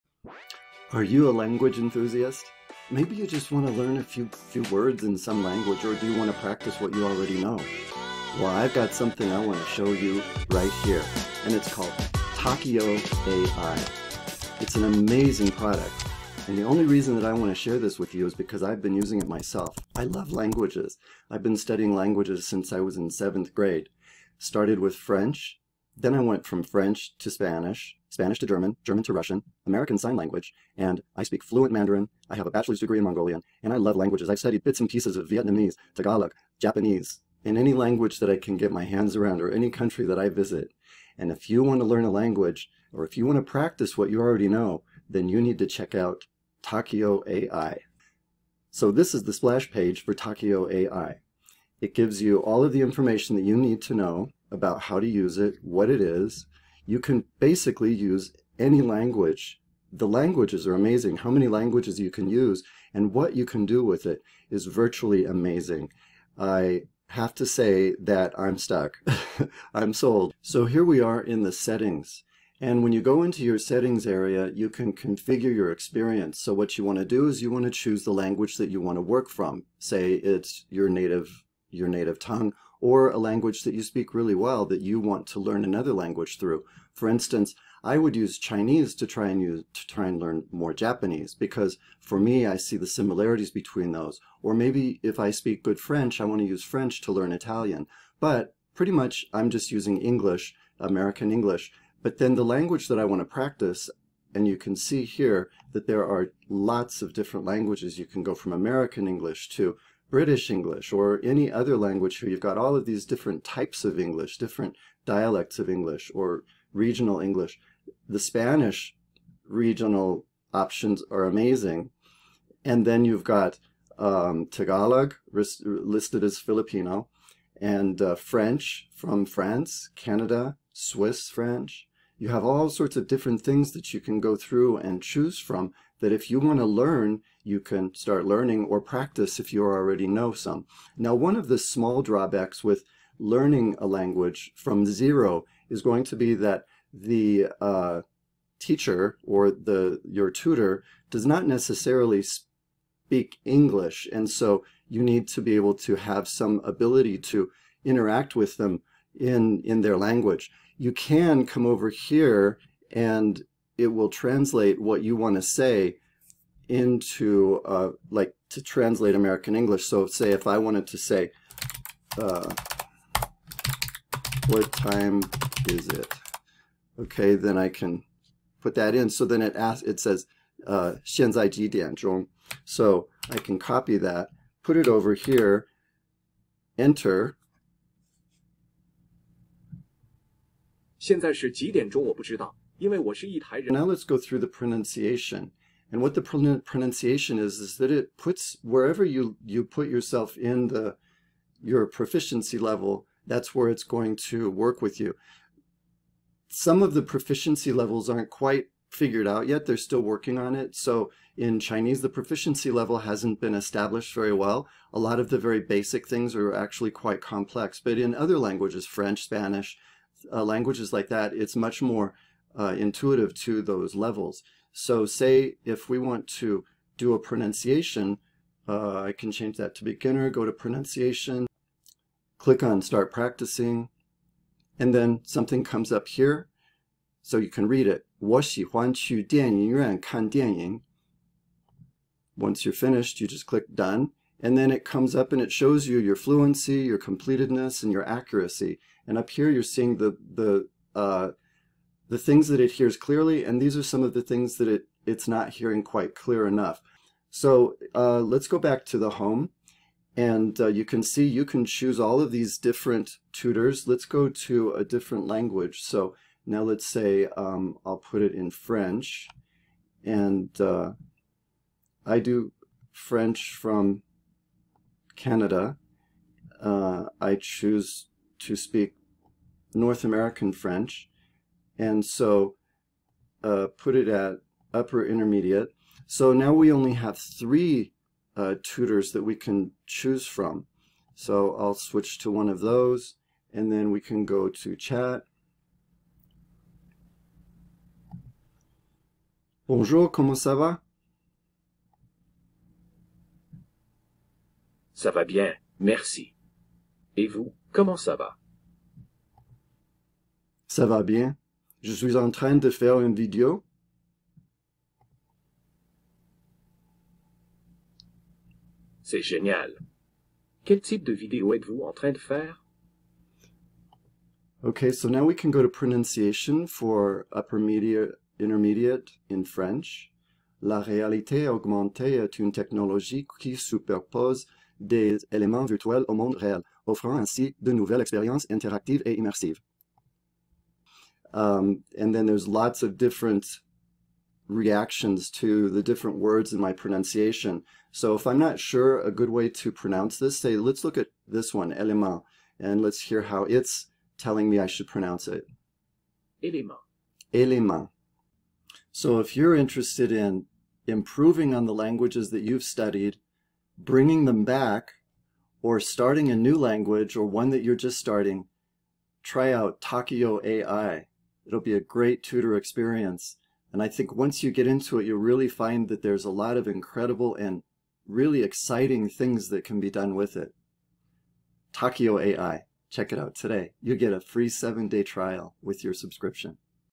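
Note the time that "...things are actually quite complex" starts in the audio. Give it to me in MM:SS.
03:36.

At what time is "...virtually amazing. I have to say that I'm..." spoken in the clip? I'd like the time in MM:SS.
01:04.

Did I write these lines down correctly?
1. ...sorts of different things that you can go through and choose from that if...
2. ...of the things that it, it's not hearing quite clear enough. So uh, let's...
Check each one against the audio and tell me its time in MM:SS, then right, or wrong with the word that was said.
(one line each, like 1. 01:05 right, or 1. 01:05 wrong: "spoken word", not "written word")
1. 02:12 right
2. 04:14 right.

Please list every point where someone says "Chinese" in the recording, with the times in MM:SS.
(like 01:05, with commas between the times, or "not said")
01:28, 03:31.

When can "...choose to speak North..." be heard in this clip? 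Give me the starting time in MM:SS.
04:37.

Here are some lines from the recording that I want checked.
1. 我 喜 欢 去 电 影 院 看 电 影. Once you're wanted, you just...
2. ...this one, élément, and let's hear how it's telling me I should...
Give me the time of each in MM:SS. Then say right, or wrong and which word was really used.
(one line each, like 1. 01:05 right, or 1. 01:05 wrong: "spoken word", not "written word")
1. 03:58 wrong: "finished", not "wanted"
2. 05:51 right.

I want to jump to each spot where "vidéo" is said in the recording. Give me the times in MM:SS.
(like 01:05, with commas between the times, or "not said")
05:13, 05:21.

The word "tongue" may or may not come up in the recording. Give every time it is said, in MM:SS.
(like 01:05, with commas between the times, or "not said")
01:22.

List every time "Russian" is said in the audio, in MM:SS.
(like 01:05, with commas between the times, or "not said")
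00:29.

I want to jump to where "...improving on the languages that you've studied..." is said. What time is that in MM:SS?
06:00.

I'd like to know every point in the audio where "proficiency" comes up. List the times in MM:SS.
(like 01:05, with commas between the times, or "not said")
03:21, 03:27, 03:32.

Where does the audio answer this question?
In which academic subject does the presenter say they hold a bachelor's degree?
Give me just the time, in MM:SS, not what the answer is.
00:33.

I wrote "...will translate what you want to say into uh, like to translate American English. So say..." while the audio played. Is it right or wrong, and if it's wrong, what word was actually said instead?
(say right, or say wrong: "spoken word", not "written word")
right.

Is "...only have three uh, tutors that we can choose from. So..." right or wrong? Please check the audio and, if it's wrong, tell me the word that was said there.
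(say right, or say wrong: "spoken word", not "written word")
right.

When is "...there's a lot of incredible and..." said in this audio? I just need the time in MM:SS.
06:16.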